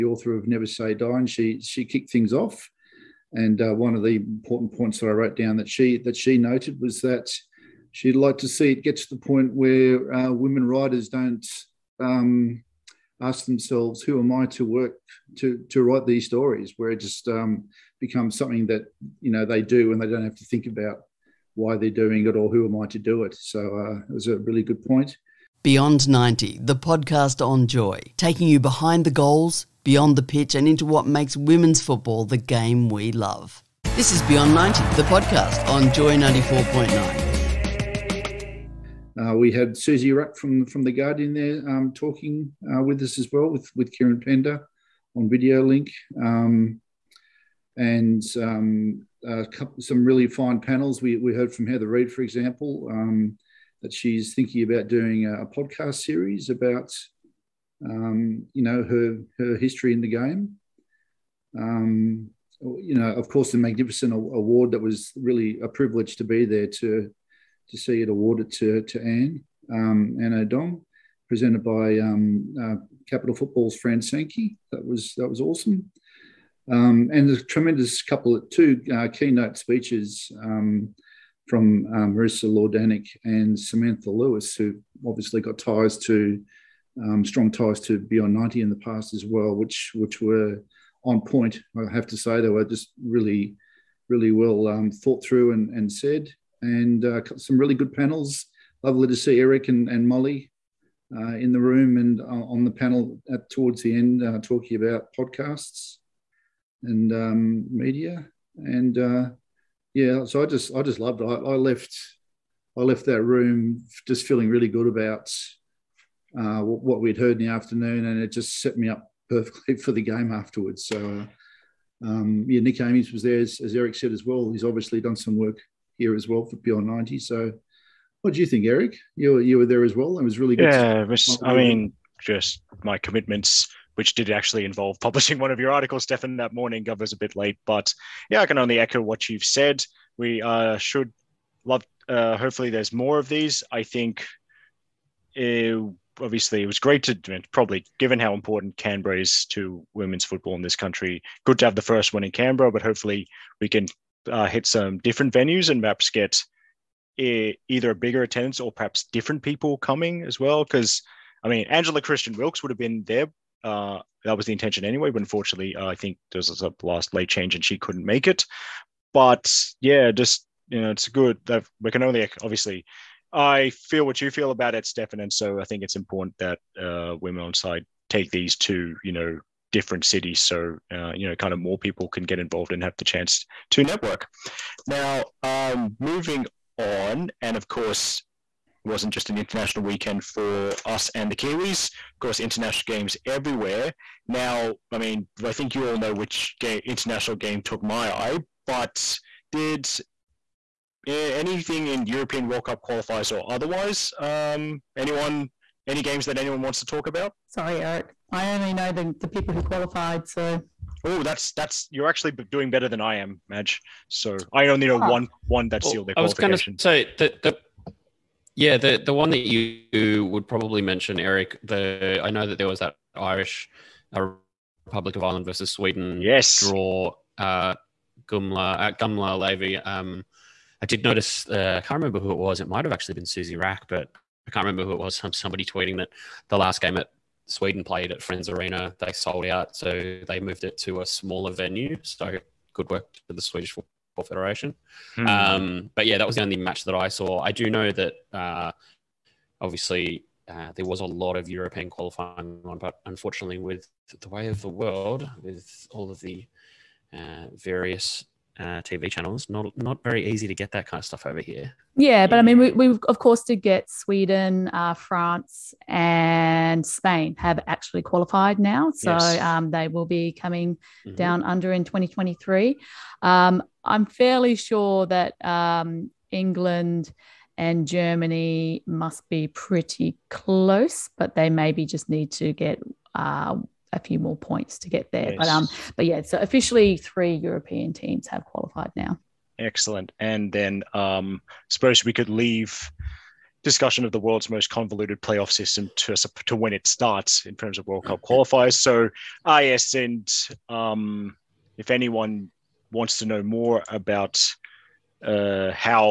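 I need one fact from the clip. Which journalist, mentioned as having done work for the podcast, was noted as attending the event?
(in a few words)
Nick Ames.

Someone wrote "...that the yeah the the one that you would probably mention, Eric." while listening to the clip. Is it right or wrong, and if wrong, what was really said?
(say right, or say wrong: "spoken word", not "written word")
right.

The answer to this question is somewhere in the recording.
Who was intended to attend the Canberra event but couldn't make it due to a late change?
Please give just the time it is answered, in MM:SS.
02:41.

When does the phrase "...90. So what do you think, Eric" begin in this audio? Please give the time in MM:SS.
02:06.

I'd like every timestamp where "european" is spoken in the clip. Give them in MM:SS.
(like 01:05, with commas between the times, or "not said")
03:22, 04:11, 04:47.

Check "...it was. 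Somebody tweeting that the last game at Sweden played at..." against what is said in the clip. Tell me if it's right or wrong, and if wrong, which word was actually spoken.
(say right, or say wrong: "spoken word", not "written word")
right.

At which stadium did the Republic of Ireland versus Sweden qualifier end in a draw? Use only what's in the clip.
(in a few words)
Gamla Ullevi.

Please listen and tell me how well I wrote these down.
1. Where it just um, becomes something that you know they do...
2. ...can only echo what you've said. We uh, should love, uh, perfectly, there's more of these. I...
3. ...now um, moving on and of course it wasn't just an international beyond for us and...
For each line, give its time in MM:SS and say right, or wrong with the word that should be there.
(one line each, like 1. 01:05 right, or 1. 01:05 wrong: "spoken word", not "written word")
1. 00:16 right
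2. 02:18 wrong: "hopefully", not "perfectly"
3. 03:04 wrong: "weekend", not "beyond".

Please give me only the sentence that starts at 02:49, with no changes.
But yeah, just you know, it's good.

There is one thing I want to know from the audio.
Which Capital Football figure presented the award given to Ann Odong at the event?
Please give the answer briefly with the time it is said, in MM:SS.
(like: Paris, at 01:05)
Fran Sankey, at 01:13.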